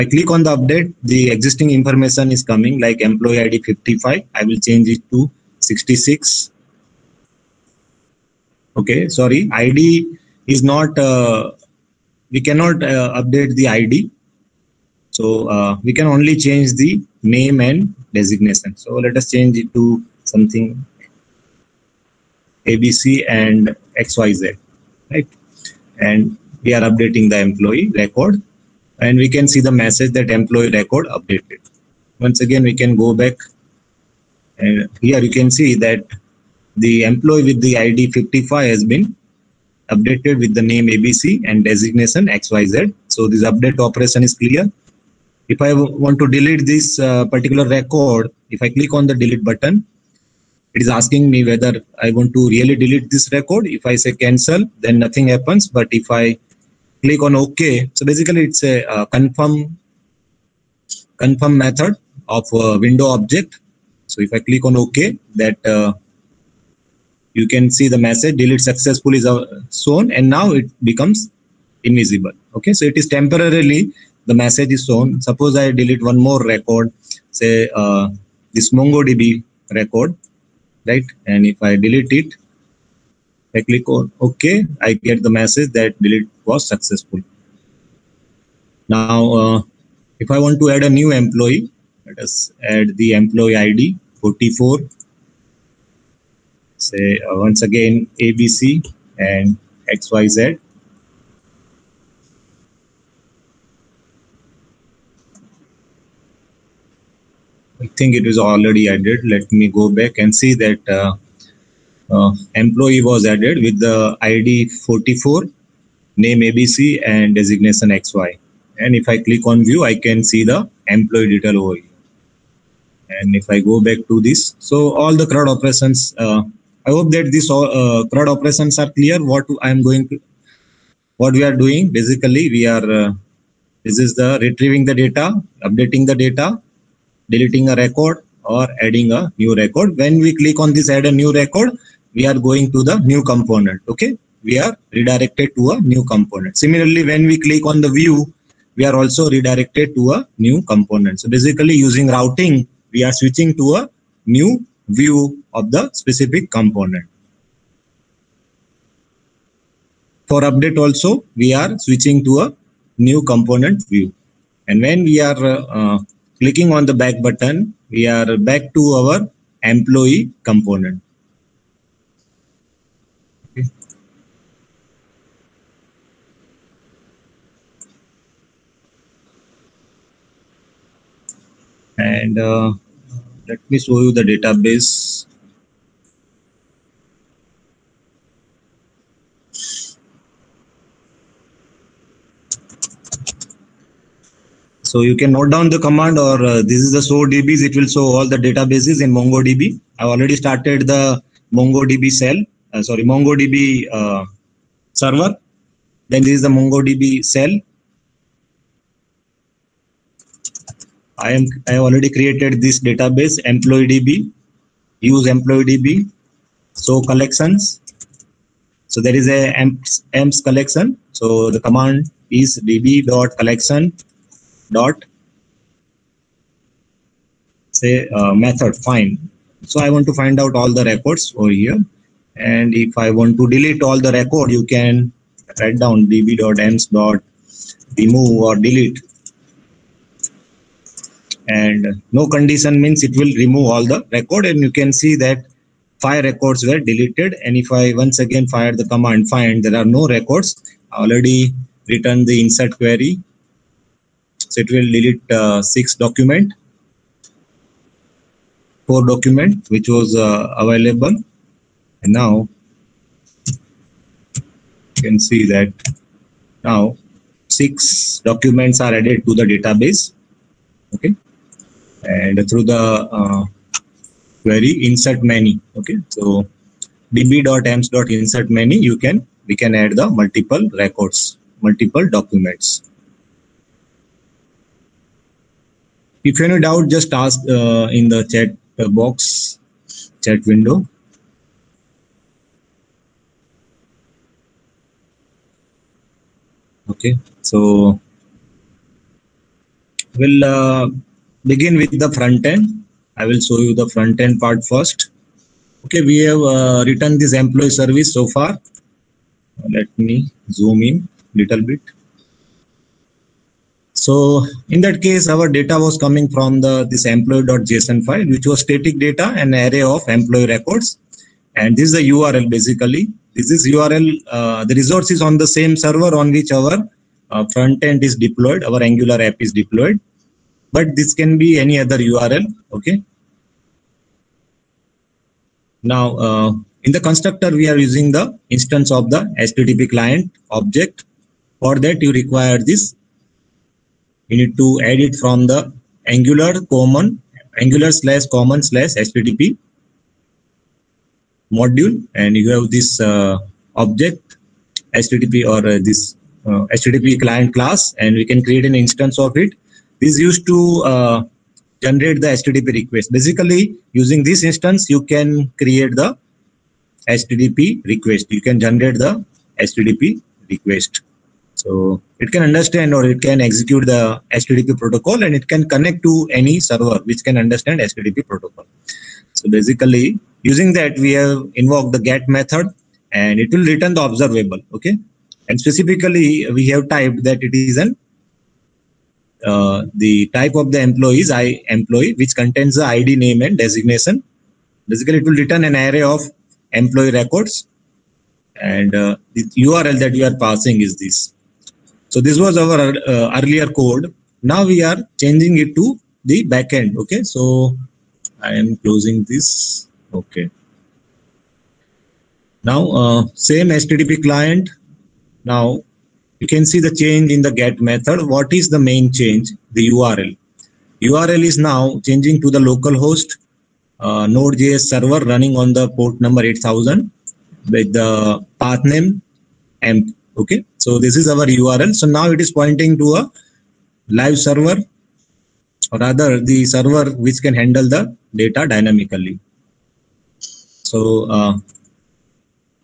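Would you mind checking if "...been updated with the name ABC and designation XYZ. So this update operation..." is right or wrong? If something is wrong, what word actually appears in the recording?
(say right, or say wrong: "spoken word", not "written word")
right.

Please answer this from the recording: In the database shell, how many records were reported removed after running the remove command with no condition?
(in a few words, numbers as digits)
5.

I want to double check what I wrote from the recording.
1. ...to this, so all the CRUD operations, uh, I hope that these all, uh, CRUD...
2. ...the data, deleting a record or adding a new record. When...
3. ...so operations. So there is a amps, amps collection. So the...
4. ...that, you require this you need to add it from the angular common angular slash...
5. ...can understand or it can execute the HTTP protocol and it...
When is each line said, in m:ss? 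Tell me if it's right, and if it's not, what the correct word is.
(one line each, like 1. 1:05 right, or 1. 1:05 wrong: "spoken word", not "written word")
1. 2:04 right
2. 2:16 right
3. 3:36 wrong: "collections", not "operations"
4. 5:41 right
5. 6:12 right.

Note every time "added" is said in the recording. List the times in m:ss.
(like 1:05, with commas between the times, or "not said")
1:48, 1:53, 4:28.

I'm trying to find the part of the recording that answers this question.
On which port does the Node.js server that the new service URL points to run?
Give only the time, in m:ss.
7:06.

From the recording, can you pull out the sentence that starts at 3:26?
Then this is the MongoDB shell.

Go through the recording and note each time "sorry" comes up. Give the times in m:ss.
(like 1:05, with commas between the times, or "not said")
0:09, 3:22.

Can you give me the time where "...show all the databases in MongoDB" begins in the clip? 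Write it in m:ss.
3:17.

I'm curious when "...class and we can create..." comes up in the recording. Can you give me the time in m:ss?
5:57.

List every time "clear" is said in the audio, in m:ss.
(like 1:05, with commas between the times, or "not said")
0:44, 2:08.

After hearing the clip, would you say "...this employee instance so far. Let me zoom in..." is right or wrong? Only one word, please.
wrong.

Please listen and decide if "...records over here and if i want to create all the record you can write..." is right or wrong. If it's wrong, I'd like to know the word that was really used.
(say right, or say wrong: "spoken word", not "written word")
wrong: "delete", not "create".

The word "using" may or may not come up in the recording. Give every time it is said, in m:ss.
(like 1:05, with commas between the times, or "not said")
2:31, 5:37, 6:03, 6:20.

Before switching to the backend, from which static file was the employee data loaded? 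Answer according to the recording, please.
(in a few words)
employee.json.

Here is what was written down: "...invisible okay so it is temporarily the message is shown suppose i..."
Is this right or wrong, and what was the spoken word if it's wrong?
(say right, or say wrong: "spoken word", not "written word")
right.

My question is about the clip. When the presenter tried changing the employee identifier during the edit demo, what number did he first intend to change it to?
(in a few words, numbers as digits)
66.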